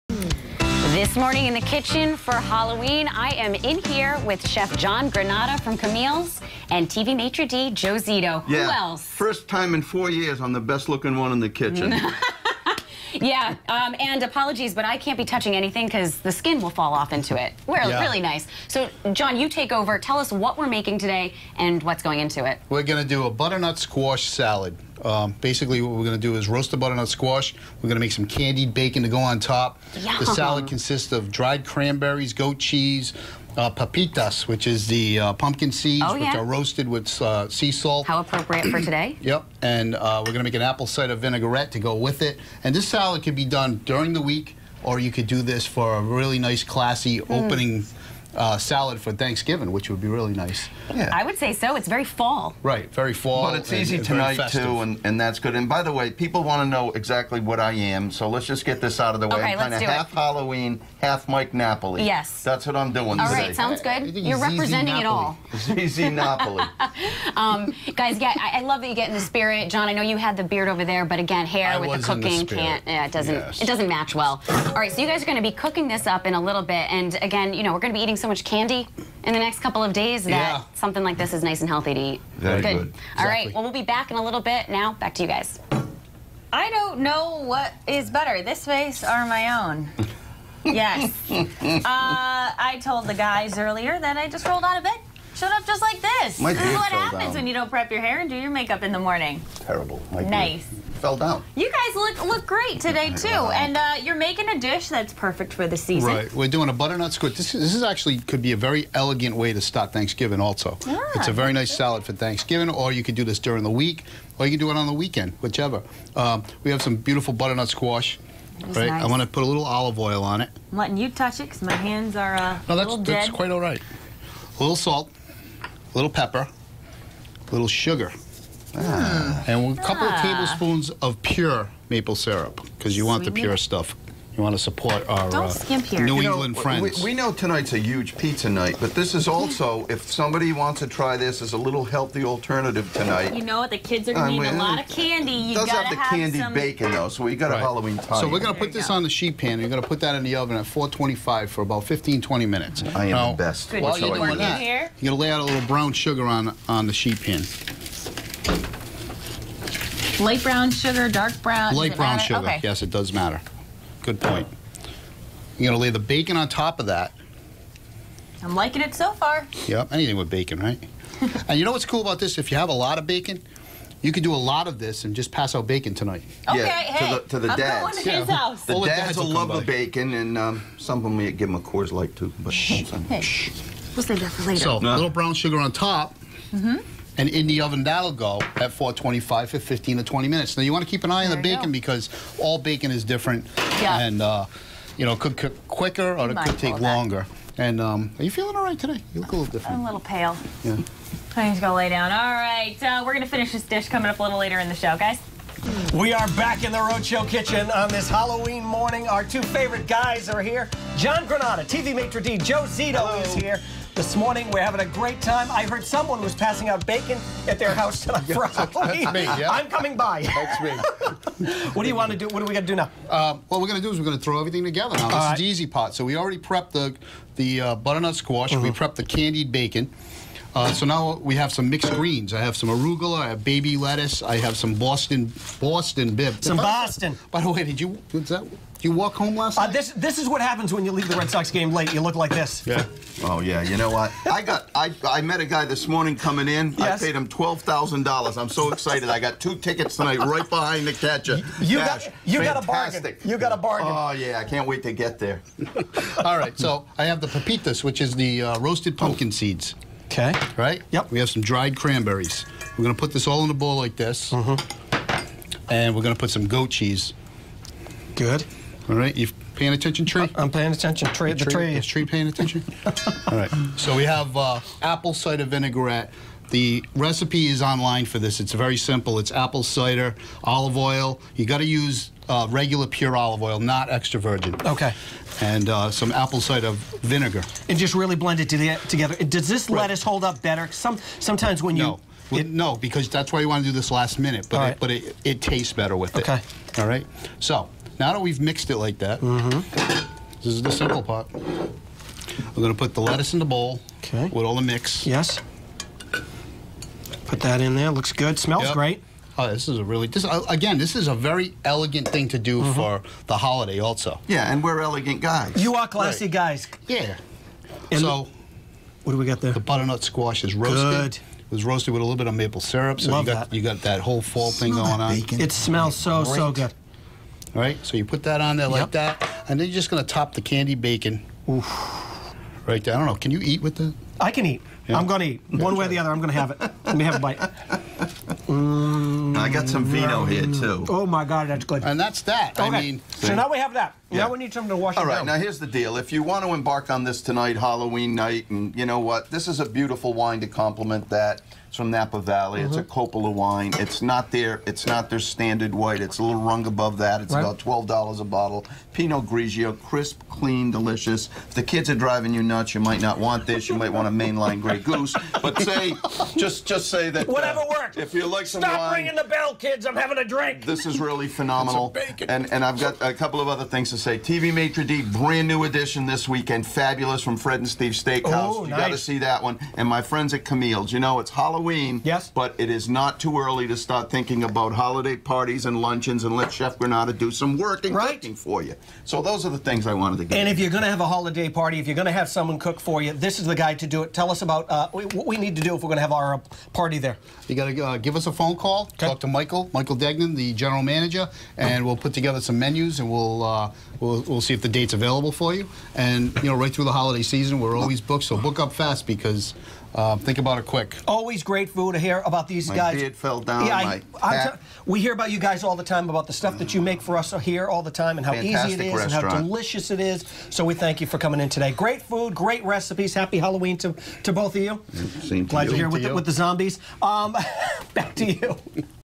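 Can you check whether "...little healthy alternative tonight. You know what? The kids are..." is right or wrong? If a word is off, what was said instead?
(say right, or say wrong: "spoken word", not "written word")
right.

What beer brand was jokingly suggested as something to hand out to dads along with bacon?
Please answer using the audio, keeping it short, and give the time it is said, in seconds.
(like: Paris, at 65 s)
Coors Light, at 181 s.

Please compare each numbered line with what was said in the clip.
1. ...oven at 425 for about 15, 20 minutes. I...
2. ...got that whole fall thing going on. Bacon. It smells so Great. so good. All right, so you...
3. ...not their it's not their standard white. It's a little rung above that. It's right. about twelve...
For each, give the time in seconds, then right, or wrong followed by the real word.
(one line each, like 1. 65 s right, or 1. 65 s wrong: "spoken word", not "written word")
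1. 150 s right
2. 323 s right
3. 354 s right.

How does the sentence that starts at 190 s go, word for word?
Now you want to keep an eye there on the bacon go.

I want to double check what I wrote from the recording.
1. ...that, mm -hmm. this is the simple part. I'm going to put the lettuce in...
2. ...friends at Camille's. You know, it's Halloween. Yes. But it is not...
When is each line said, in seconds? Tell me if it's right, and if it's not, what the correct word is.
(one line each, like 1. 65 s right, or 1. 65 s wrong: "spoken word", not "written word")
1. 298 s right
2. 380 s right.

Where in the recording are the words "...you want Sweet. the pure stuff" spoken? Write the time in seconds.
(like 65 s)
132 s.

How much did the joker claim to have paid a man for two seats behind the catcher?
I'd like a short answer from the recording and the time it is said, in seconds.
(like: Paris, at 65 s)
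$12,000, at 247 s.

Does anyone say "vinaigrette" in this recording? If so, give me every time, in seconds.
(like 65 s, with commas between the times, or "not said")
41 s, 275 s.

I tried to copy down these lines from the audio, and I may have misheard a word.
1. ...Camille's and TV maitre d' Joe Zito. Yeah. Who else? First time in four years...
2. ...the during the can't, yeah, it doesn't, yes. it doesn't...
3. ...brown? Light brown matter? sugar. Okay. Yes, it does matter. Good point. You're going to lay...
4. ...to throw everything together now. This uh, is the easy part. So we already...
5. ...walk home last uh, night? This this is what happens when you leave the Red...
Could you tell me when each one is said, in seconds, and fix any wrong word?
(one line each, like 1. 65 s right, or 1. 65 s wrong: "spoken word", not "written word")
1. 5 s right
2. 71 s wrong: "cooking", not "during"
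3. 161 s right
4. 224 s right
5. 238 s right.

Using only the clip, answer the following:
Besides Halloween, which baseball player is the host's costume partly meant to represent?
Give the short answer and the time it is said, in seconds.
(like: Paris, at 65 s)
Mike Napoli, at 61 s.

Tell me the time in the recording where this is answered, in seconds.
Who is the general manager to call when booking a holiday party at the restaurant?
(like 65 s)
399 s.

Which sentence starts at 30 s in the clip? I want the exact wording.
The salad consists of dried cranberries, goat cheese, uh, papitas, which is the uh, pumpkin seeds, oh, yeah.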